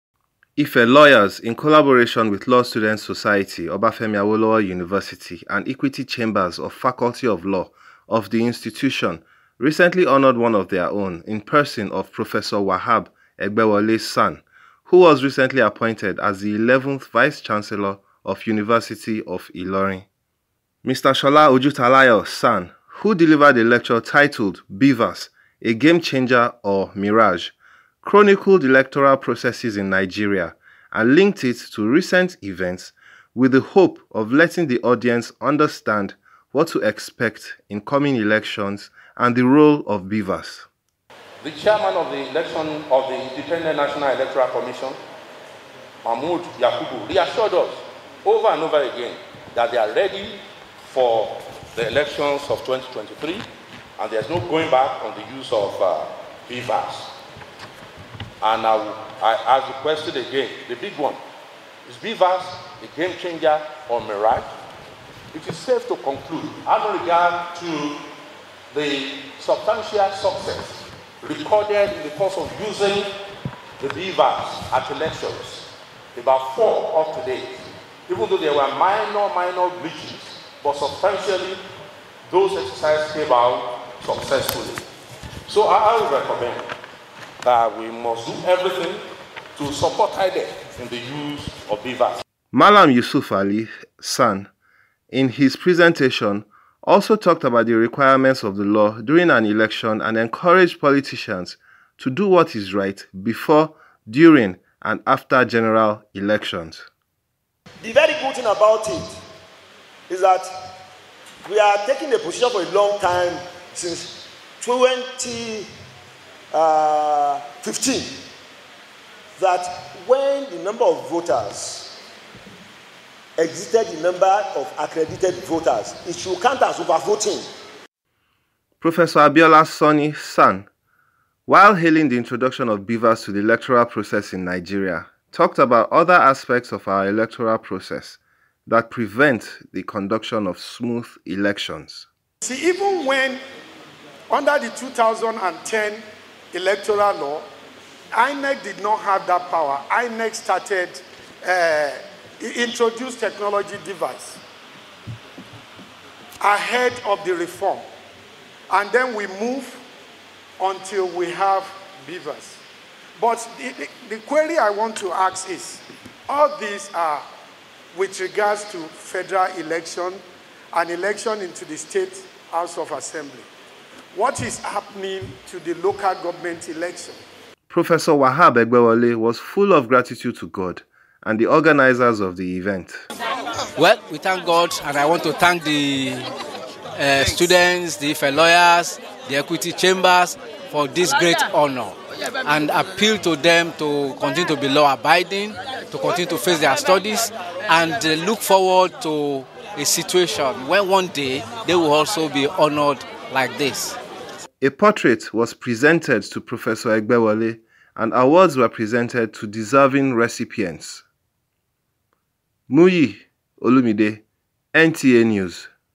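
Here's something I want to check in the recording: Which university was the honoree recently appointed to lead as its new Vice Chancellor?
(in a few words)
University of Ilorin.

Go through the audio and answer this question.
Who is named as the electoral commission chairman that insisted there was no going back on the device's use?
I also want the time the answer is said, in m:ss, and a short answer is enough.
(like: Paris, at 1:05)
Mahmoud Yakubu, at 0:46.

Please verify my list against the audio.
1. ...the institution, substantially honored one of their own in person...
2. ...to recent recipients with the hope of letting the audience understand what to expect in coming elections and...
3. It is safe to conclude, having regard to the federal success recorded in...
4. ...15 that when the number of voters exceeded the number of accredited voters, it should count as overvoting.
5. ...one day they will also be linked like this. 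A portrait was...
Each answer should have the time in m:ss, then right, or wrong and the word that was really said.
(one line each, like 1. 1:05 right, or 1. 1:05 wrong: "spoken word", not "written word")
1. 0:08 wrong: "recently", not "substantially"
2. 0:31 wrong: "events", not "recipients"
3. 1:05 wrong: "substantial", not "federal"
4. 1:57 right
5. 3:20 wrong: "honored", not "linked".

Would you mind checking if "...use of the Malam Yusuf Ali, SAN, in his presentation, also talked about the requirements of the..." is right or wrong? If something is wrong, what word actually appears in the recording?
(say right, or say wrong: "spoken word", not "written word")
right.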